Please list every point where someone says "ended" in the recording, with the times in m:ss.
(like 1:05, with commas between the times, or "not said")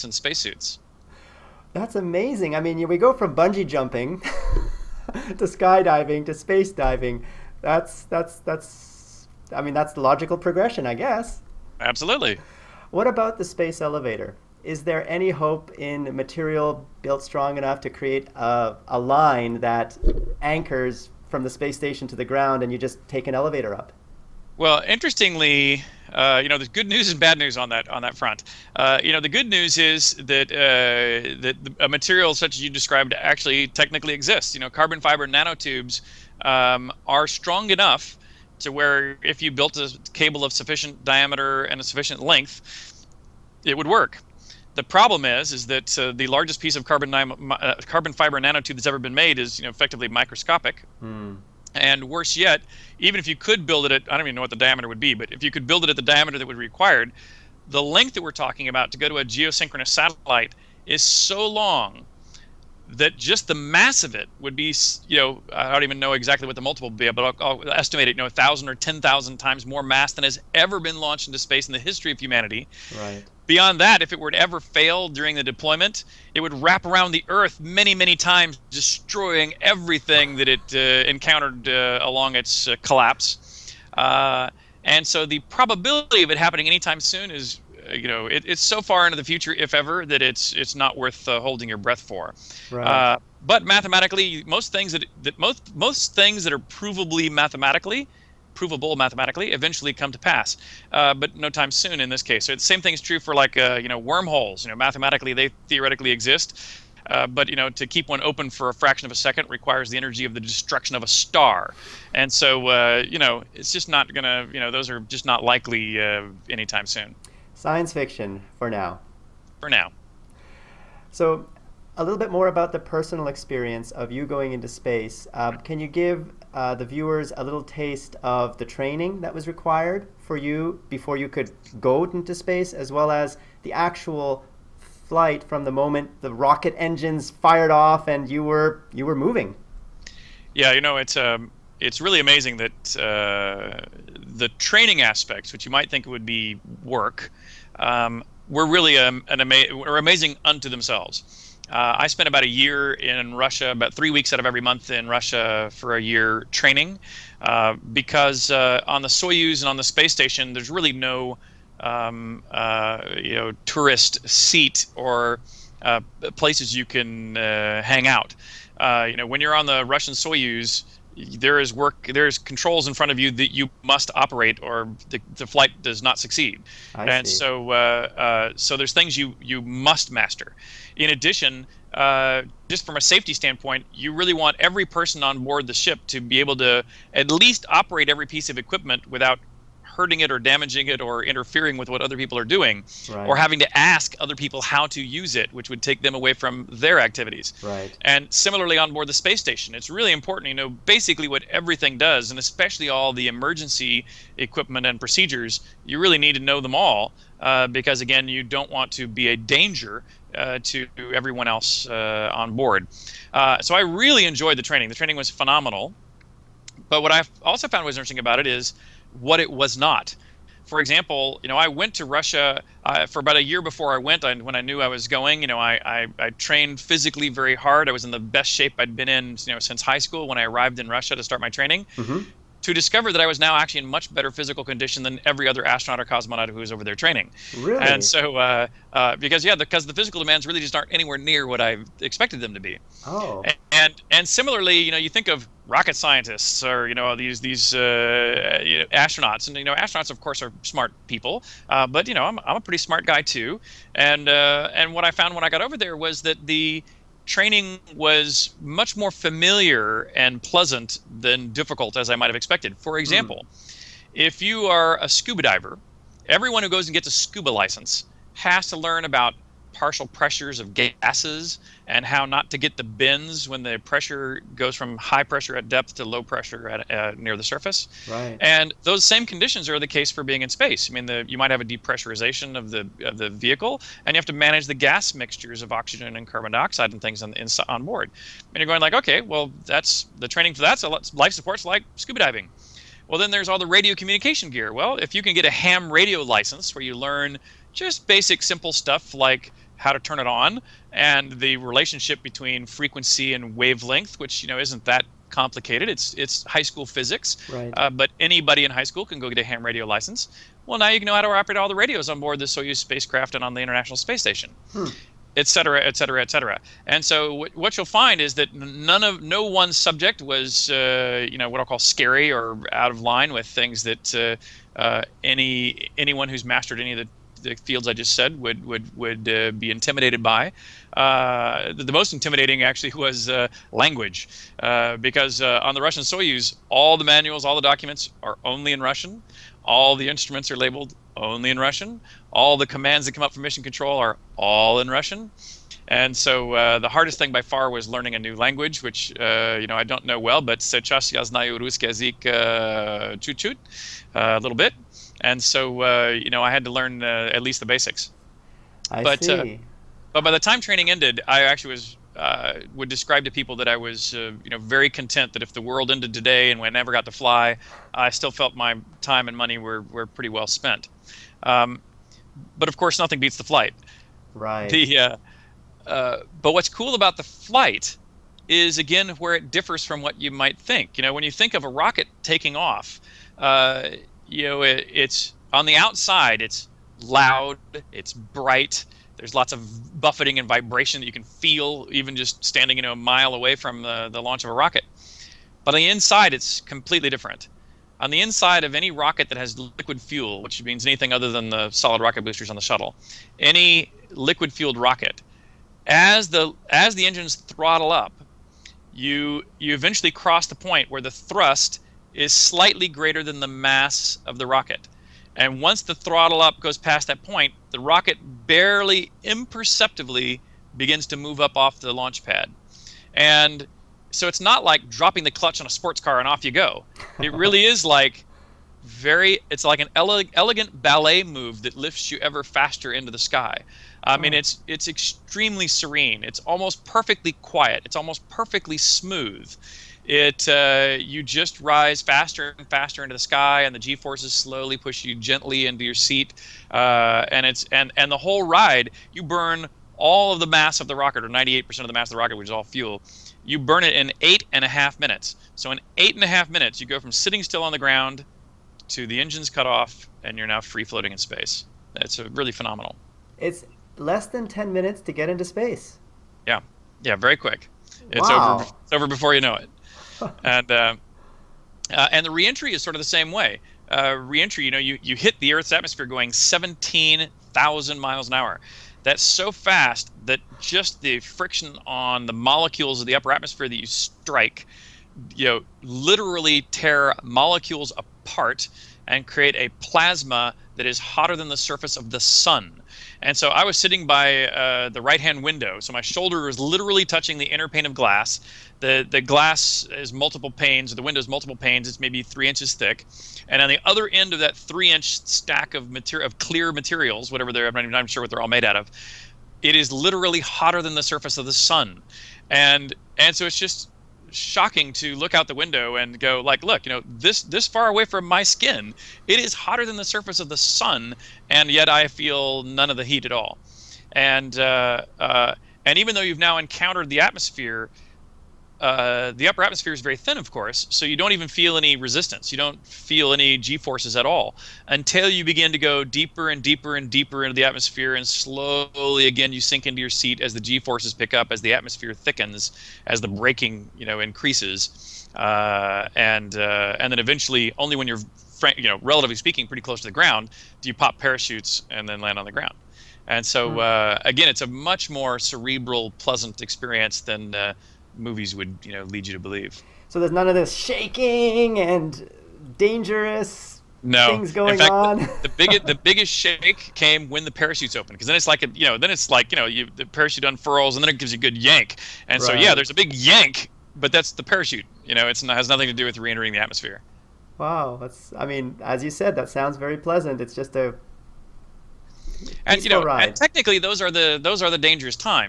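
6:00, 6:05.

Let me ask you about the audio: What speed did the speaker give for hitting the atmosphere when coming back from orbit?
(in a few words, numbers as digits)
17,000 miles an hour.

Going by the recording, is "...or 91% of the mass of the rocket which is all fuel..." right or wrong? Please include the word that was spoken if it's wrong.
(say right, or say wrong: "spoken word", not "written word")
wrong: "98", not "91".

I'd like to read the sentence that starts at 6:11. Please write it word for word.
Um, but of course, nothing beats the flight.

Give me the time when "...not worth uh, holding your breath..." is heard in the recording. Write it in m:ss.
1:30.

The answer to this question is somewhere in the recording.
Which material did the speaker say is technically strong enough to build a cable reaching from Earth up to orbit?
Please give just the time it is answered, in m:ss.
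0:34.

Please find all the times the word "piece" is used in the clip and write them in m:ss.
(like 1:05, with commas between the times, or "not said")
0:46, 3:08.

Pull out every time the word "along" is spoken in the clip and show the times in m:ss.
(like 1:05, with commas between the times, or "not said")
1:22.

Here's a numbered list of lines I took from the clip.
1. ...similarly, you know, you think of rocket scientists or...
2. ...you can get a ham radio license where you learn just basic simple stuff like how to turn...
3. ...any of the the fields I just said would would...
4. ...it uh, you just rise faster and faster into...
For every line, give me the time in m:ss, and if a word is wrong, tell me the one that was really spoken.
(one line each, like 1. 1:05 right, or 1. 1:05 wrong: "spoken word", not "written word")
1. 4:04 right
2. 4:55 right
3. 5:26 right
4. 7:20 right.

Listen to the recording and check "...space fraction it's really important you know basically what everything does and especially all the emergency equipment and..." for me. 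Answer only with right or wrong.
wrong.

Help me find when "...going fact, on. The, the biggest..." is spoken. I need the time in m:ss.
9:24.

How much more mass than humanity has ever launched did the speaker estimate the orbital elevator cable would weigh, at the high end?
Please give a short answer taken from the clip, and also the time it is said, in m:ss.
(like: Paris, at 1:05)
10,000 times, at 1:08.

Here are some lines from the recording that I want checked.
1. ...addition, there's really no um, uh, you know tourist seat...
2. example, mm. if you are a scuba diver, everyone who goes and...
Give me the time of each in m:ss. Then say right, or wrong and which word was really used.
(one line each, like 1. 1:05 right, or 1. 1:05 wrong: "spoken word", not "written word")
1. 2:40 wrong: "station", not "addition"
2. 4:22 right.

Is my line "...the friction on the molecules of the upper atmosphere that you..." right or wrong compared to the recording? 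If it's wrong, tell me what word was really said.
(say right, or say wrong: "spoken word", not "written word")
right.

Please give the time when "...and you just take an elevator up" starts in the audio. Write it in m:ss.
0:22.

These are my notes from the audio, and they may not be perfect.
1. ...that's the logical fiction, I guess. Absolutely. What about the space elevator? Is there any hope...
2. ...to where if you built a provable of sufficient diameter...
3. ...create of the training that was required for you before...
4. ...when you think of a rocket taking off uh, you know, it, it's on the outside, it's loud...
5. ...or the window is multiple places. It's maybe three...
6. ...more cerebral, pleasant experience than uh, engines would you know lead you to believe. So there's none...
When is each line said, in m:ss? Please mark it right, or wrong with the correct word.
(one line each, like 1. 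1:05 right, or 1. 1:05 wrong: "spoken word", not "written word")
1. 0:09 wrong: "progression", not "fiction"
2. 0:38 wrong: "cable", not "provable"
3. 2:07 wrong: "taste", not "create"
4. 6:21 right
5. 8:20 wrong: "panes", not "places"
6. 9:15 wrong: "movies", not "engines".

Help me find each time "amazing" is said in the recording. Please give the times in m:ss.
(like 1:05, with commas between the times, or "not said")
0:01, 2:22, 2:29.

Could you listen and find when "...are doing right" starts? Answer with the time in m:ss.
3:12.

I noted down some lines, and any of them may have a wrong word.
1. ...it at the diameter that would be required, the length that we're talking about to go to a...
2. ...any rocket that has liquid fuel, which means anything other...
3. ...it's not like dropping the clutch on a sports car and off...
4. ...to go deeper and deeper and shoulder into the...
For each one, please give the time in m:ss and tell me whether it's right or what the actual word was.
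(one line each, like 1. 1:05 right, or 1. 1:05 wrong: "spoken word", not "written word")
1. 0:55 right
2. 6:38 right
3. 7:04 right
4. 8:55 wrong: "deeper", not "shoulder".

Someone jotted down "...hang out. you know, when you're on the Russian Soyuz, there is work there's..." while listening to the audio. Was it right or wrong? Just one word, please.
right.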